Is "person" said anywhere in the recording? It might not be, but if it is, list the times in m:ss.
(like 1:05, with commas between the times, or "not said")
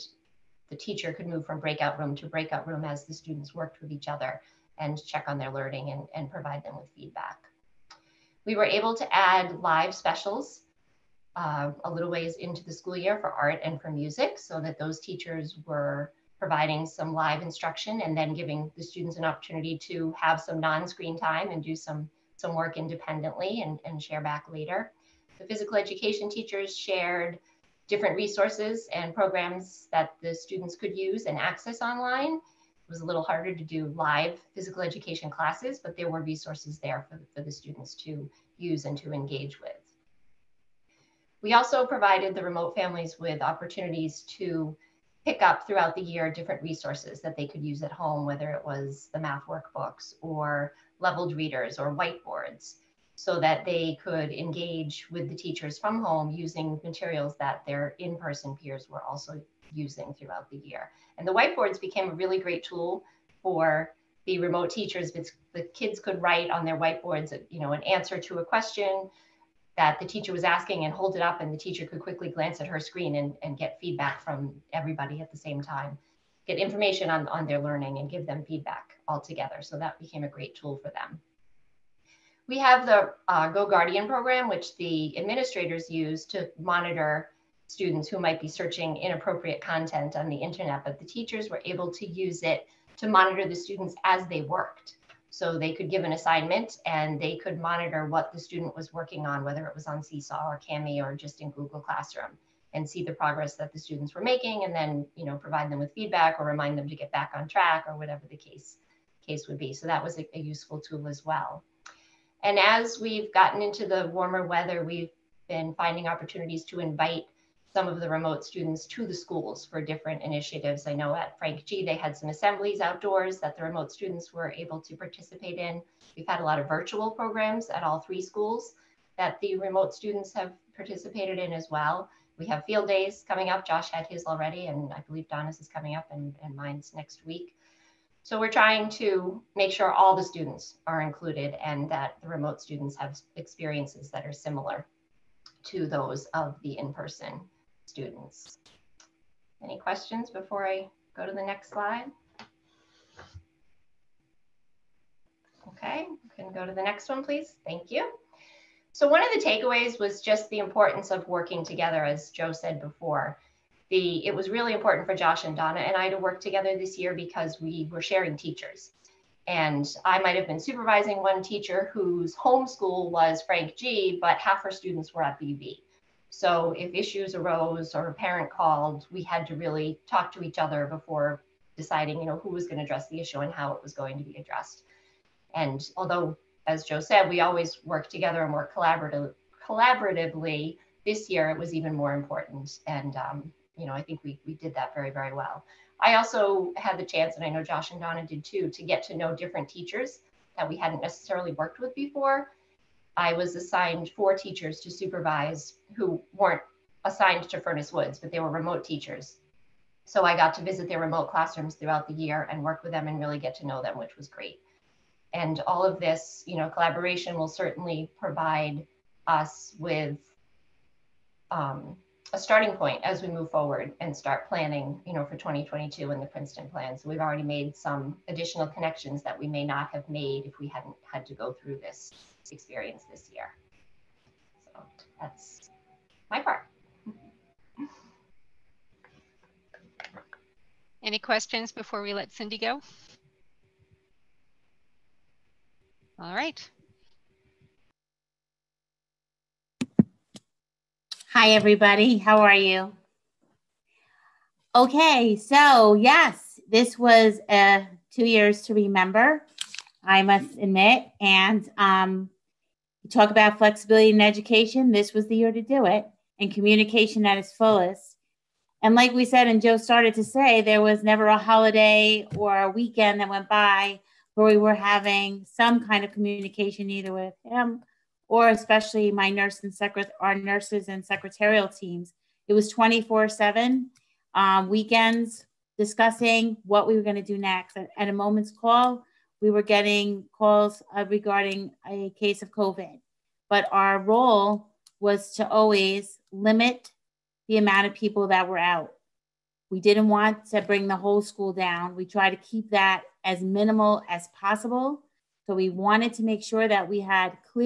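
0:58, 2:26.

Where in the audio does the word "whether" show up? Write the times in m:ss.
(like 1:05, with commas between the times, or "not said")
0:48, 1:39.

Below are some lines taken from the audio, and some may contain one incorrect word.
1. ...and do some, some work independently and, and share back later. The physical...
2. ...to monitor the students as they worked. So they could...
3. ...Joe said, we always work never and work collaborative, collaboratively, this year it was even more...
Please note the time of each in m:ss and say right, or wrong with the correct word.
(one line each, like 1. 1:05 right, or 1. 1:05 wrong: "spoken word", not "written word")
1. 0:21 right
2. 1:32 right
3. 3:06 wrong: "together", not "never".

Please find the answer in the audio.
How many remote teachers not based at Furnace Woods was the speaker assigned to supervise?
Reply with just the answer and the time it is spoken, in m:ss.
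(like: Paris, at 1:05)
4, at 3:24.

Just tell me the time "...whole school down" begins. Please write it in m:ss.
5:00.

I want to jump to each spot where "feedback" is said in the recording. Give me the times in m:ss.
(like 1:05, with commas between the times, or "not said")
0:06, 1:13, 1:18, 1:45.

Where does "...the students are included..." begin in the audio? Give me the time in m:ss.
2:20.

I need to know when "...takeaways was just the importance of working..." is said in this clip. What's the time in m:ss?
2:39.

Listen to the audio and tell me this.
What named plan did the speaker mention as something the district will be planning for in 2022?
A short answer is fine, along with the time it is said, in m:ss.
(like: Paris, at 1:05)
The Princeton plan, at 3:46.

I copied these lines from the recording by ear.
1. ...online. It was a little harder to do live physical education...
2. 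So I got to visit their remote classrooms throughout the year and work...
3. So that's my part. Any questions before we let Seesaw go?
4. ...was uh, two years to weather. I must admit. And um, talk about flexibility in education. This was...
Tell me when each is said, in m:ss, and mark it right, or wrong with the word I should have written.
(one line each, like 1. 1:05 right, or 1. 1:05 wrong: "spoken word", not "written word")
1. 0:31 right
2. 3:30 right
3. 3:54 wrong: "Cindy", not "Seesaw"
4. 4:16 wrong: "remember", not "weather".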